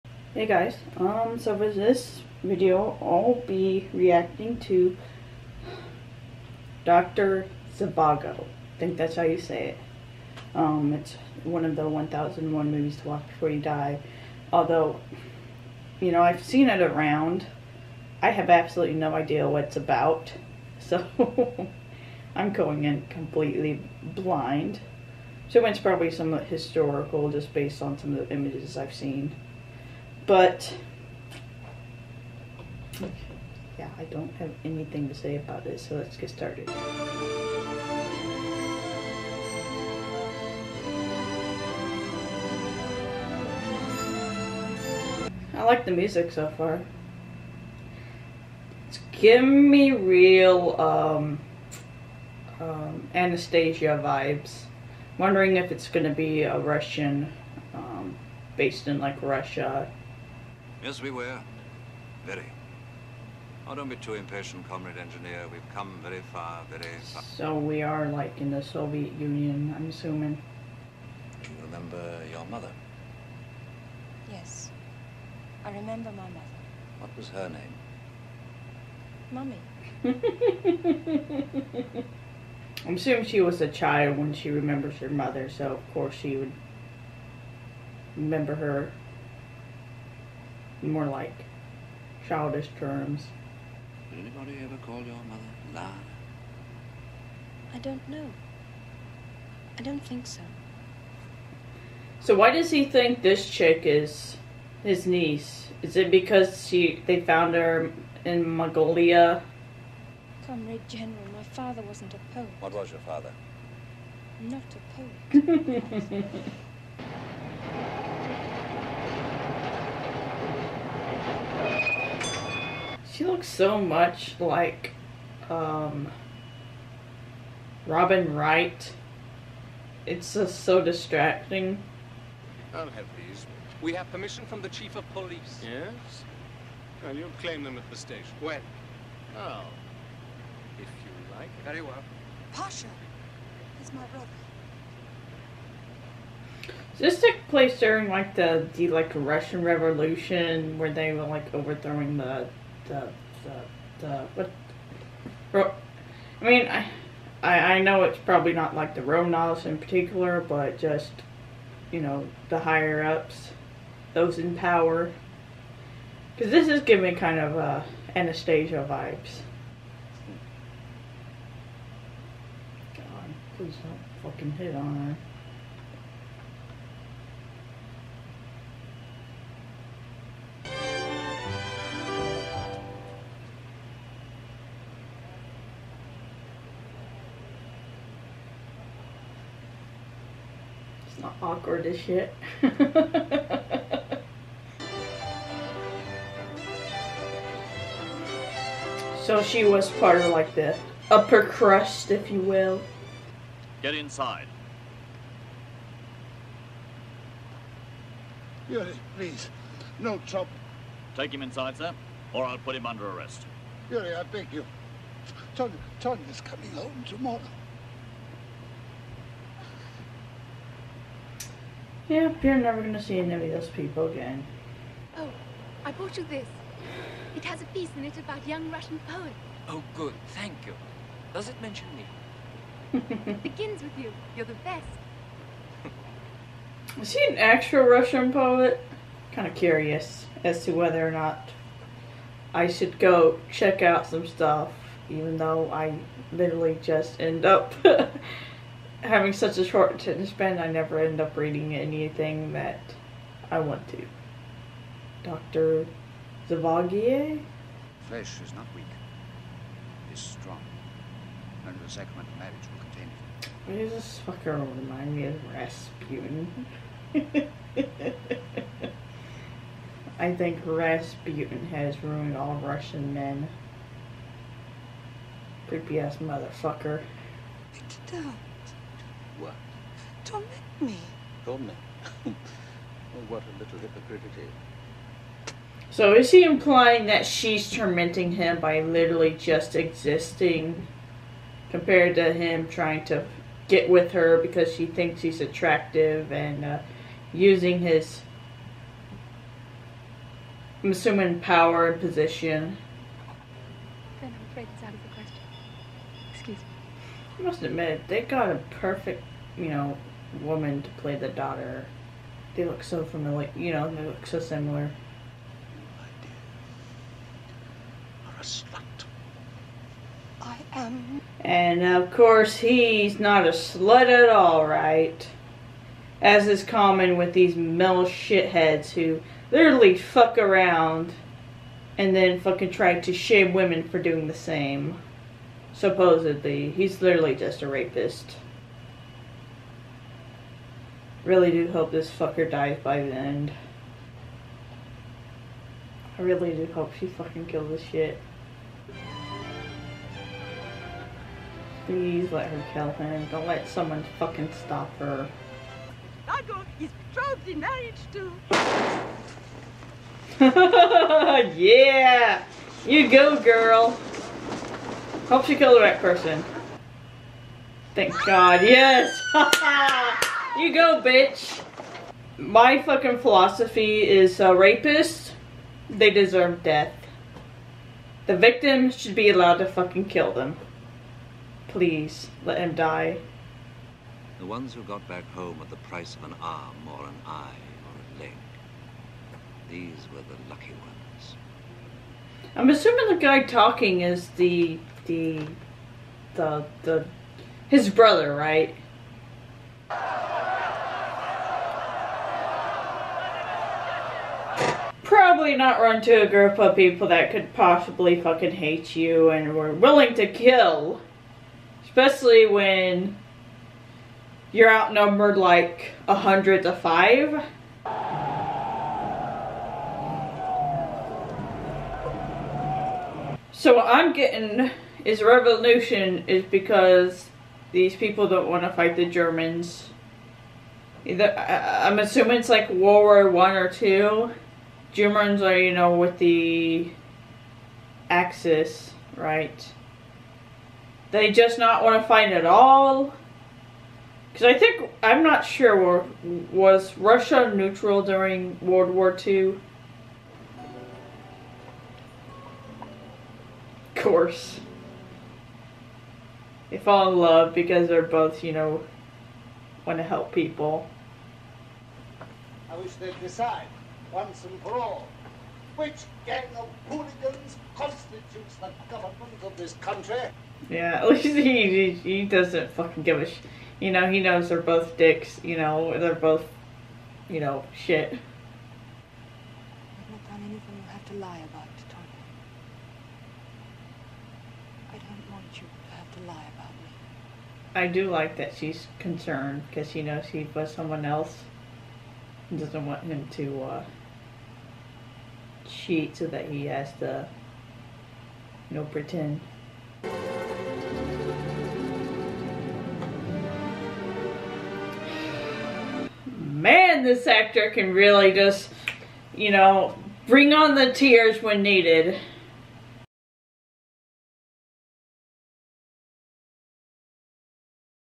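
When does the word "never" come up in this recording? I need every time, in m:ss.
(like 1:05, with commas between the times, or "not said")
3:42, 4:10.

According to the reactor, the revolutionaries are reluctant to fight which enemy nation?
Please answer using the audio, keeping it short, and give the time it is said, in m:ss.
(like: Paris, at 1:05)
the Germans, at 7:09.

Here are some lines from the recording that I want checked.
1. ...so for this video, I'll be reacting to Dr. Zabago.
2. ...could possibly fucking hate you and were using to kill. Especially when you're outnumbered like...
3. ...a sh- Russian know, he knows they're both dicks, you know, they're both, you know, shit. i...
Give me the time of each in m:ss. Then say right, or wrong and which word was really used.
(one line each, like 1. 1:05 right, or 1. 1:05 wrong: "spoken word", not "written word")
1. 0:01 right
2. 6:47 wrong: "willing", not "using"
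3. 7:53 wrong: "You", not "Russian".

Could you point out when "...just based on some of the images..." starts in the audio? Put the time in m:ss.
0:27.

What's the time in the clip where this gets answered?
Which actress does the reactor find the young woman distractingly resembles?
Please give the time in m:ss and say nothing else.
2:07.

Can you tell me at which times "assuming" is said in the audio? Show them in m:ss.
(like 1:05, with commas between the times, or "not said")
1:09, 1:22, 5:00, 6:32, 7:11.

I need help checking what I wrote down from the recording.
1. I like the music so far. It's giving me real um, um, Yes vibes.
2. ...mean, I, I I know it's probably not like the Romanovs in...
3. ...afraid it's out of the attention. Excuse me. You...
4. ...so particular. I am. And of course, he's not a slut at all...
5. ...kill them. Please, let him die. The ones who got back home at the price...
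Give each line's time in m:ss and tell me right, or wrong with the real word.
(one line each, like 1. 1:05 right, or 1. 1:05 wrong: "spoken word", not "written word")
1. 0:45 wrong: "Anastasia", not "Yes"
2. 2:36 right
3. 5:04 wrong: "question", not "attention"
4. 5:14 wrong: "similar", not "particular"
5. 6:20 right.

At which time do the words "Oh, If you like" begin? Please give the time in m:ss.
2:19.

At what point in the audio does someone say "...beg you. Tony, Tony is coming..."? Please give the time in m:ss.
3:34.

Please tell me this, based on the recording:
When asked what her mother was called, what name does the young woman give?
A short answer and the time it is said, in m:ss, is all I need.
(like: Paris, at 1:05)
Mummy, at 1:19.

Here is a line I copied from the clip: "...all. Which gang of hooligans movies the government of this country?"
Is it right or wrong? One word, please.
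wrong.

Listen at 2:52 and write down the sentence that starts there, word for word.
God, please don't fucking hit on her.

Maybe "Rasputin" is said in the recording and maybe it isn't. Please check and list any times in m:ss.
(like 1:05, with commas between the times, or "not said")
4:25, 4:30.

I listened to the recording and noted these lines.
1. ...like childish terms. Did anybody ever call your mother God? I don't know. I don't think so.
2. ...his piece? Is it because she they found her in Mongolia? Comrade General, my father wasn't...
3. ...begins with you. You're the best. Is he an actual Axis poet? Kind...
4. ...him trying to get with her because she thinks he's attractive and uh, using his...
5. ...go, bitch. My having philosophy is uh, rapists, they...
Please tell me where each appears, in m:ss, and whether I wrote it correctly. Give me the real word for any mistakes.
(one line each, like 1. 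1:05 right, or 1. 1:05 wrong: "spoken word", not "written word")
1. 1:31 wrong: "Lara", not "God"
2. 1:44 wrong: "niece", not "piece"
3. 3:53 wrong: "Russian", not "Axis"
4. 4:52 right
5. 6:10 wrong: "fucking", not "having".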